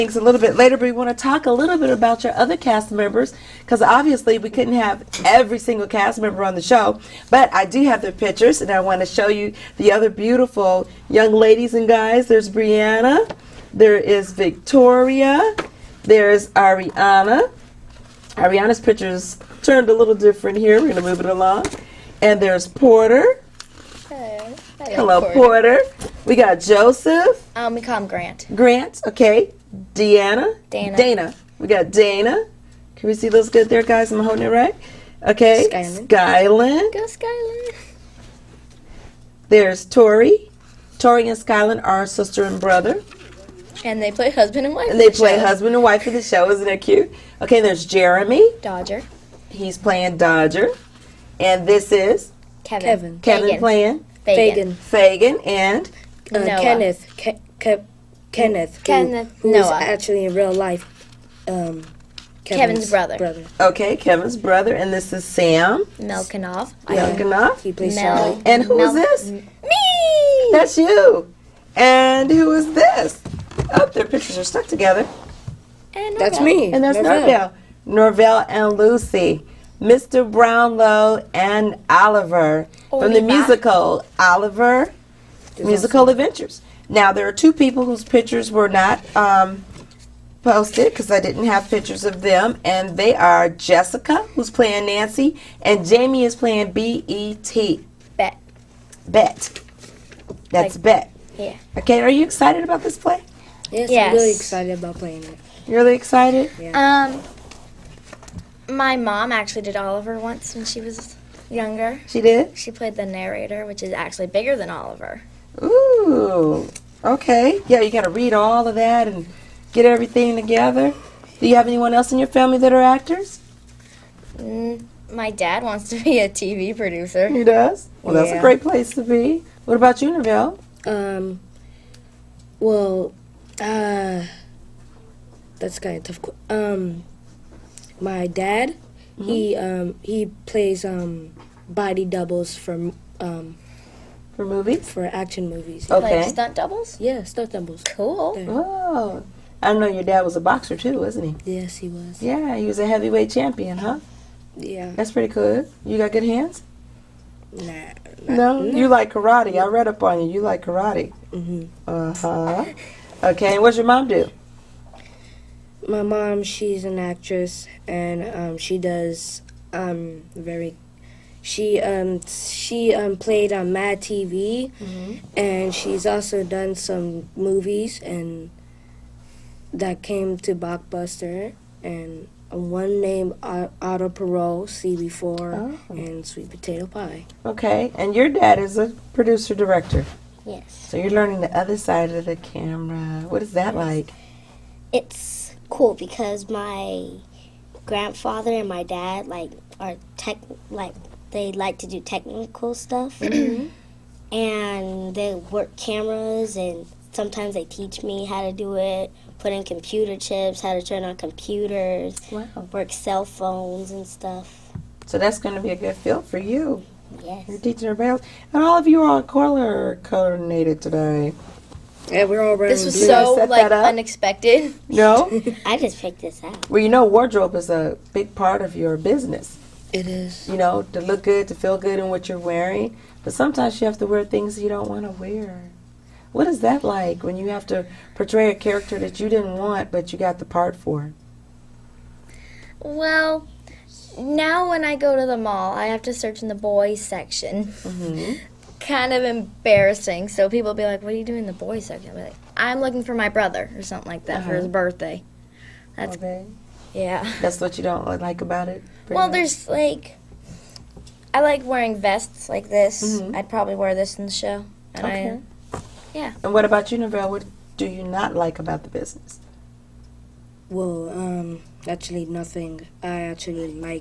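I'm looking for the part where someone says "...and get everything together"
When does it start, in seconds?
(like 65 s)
119 s.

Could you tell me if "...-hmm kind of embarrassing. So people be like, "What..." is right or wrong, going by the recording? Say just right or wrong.
right.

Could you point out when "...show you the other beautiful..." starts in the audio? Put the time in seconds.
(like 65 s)
9 s.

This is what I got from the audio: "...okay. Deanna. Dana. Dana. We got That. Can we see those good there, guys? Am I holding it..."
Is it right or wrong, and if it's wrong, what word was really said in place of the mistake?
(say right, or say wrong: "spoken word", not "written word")
wrong: "Dana", not "That".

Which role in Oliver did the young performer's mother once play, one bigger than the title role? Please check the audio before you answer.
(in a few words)
the narrator.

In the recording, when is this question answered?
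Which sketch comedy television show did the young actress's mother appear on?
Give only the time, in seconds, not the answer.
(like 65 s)
173 s.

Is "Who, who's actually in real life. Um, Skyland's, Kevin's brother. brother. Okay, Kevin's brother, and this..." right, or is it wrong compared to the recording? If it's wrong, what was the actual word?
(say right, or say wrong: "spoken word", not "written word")
wrong: "Kevin", not "Skyland".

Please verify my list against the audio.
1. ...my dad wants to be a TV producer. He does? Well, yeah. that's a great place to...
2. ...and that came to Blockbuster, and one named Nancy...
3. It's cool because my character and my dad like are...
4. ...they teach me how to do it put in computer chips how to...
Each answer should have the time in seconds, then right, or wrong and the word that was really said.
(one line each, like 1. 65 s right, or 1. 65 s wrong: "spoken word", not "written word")
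1. 125 s right
2. 178 s wrong: "Auto", not "Nancy"
3. 194 s wrong: "grandfather", not "character"
4. 207 s right.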